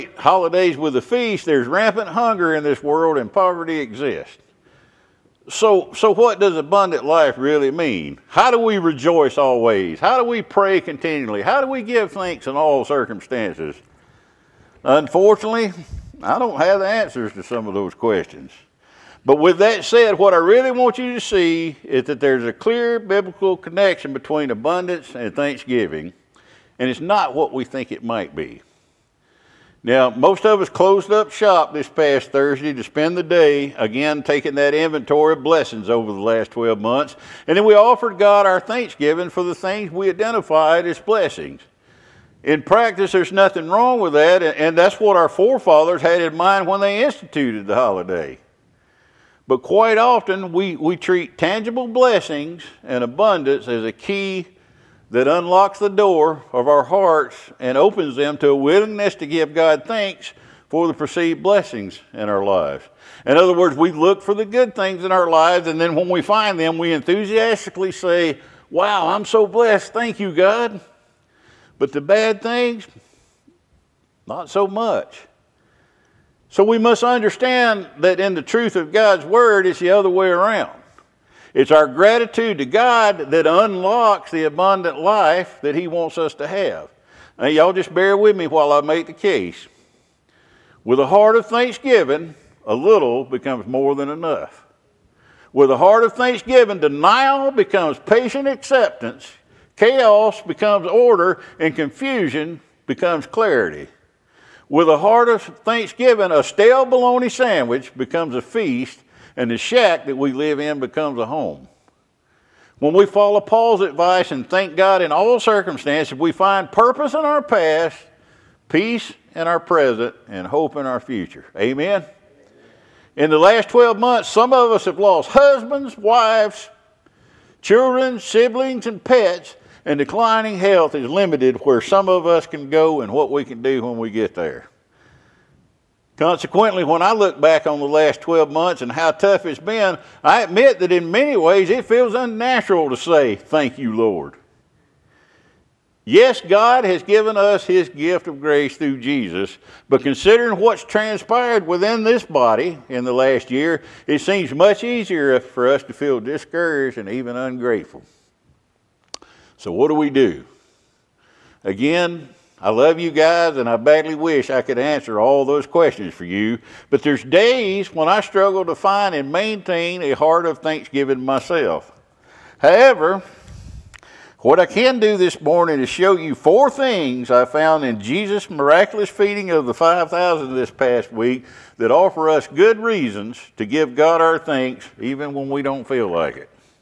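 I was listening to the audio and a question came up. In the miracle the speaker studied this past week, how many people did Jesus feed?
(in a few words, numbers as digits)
5,000.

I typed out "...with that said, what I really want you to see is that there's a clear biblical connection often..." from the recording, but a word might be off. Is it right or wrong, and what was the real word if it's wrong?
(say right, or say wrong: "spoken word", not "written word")
wrong: "between", not "often".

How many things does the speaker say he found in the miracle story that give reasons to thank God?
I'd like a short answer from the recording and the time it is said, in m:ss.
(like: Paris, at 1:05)
4, at 2:56.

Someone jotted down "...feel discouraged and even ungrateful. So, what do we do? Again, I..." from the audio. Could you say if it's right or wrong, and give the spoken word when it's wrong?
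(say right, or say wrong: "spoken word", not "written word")
right.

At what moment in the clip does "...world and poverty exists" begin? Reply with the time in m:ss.
0:02.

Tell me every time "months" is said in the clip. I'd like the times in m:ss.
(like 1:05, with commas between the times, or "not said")
0:36, 2:03, 2:18.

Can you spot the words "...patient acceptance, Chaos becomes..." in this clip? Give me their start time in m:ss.
1:37.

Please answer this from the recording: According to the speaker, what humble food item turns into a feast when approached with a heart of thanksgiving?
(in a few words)
stale bologna sandwich.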